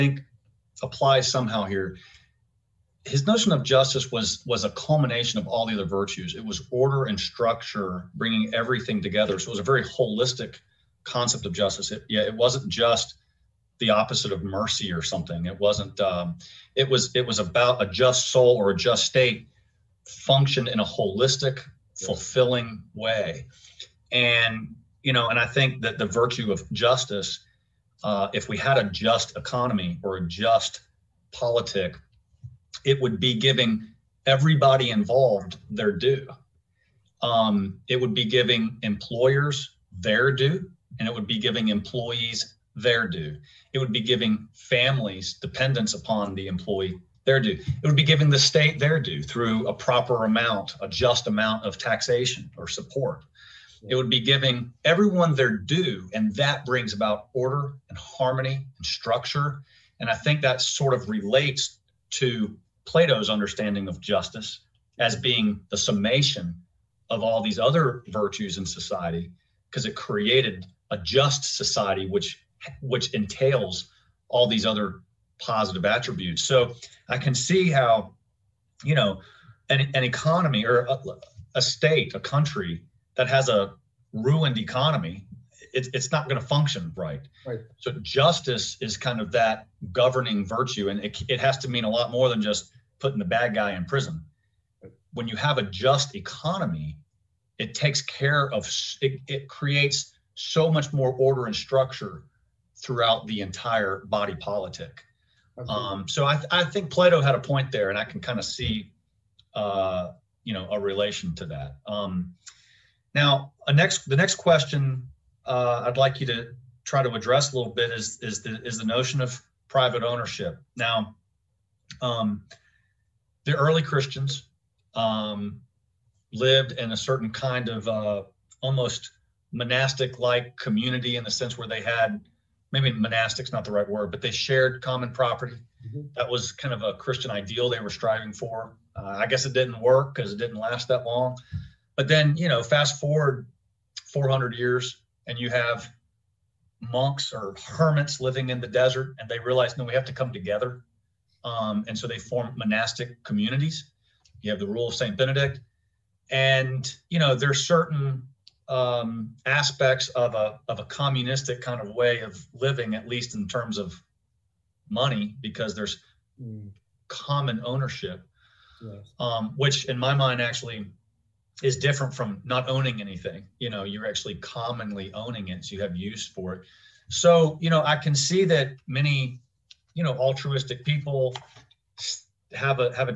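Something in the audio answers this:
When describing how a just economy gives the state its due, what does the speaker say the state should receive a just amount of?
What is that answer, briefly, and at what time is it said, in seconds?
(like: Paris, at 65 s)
taxation, at 51 s.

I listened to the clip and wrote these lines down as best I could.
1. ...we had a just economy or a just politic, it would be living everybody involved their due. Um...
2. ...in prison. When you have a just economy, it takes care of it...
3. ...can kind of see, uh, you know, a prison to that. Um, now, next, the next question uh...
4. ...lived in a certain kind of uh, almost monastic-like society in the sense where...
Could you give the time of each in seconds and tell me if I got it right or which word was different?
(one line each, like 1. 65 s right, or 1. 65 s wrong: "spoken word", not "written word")
1. 28 s wrong: "giving", not "living"
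2. 93 s right
3. 108 s wrong: "relation", not "prison"
4. 126 s wrong: "community", not "society".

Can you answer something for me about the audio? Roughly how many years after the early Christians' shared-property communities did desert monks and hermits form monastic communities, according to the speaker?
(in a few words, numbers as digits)
400.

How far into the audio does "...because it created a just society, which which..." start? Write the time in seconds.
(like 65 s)
69 s.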